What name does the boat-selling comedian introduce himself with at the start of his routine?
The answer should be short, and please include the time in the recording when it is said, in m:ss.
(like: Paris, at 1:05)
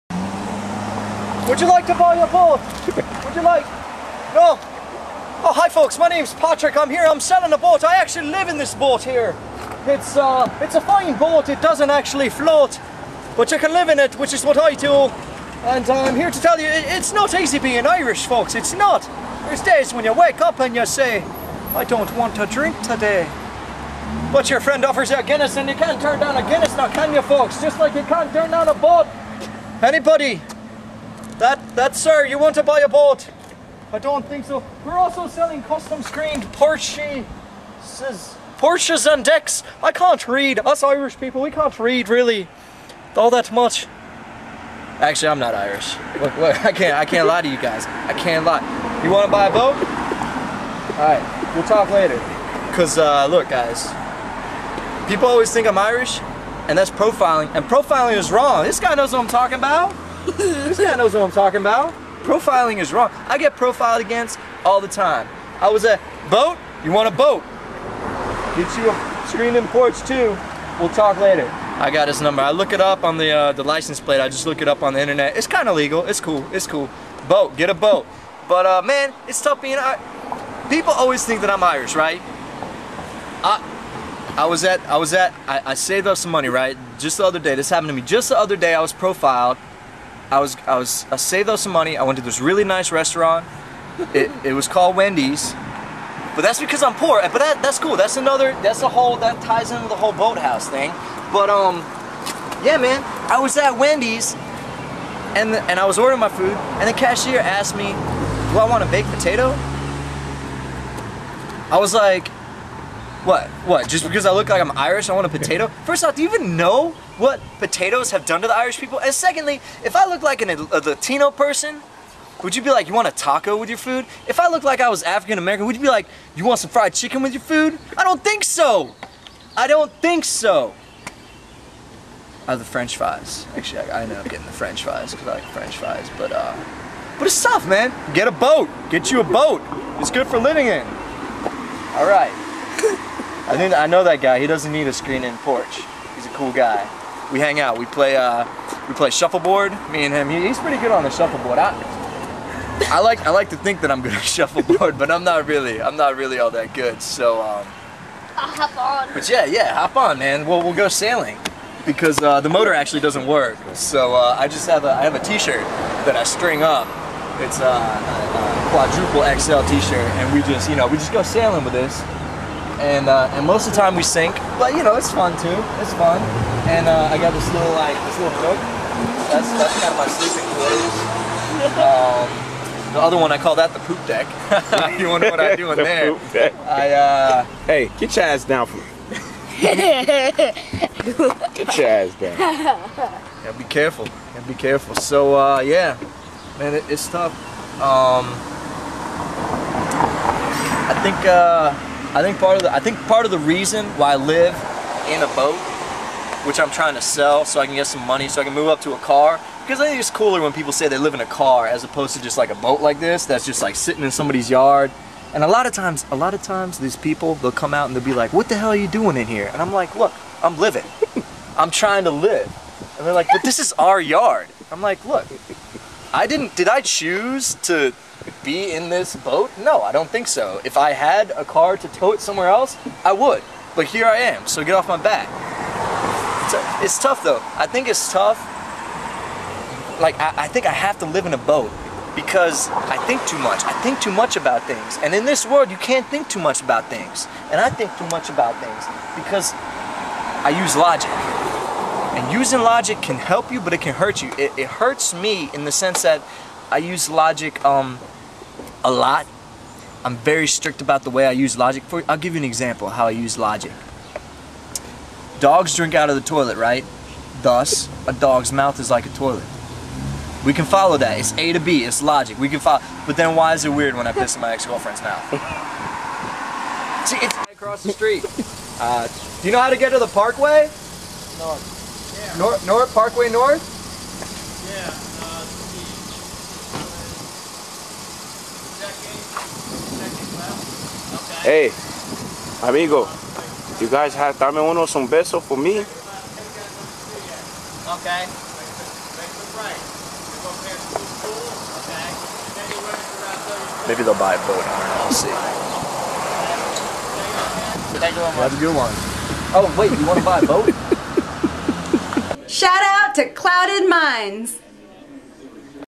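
Patrick, at 0:06.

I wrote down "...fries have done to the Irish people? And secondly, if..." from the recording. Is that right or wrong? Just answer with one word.
wrong.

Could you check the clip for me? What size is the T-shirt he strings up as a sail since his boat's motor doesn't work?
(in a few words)
Quadruple XL.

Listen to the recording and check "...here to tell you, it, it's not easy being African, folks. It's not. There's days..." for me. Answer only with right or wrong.
wrong.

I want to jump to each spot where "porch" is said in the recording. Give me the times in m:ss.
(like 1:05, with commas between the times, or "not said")
1:09, 2:25.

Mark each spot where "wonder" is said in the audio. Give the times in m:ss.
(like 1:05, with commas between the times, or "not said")
3:05.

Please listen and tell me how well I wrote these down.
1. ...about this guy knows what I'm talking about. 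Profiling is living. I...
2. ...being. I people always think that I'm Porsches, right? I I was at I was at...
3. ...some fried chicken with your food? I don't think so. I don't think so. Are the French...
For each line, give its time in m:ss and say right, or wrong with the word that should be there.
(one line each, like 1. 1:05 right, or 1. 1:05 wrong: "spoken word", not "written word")
1. 0:59 wrong: "wrong", not "living"
2. 1:19 wrong: "Irish", not "Porsches"
3. 2:06 right.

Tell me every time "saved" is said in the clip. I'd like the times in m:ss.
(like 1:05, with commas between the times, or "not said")
1:25, 1:31.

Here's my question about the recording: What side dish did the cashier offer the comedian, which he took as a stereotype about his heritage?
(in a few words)
A baked potato.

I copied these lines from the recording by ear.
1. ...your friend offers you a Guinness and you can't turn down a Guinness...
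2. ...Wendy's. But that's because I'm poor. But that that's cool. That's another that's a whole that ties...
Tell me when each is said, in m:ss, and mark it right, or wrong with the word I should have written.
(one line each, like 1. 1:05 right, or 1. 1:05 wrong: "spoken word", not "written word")
1. 0:24 right
2. 1:34 right.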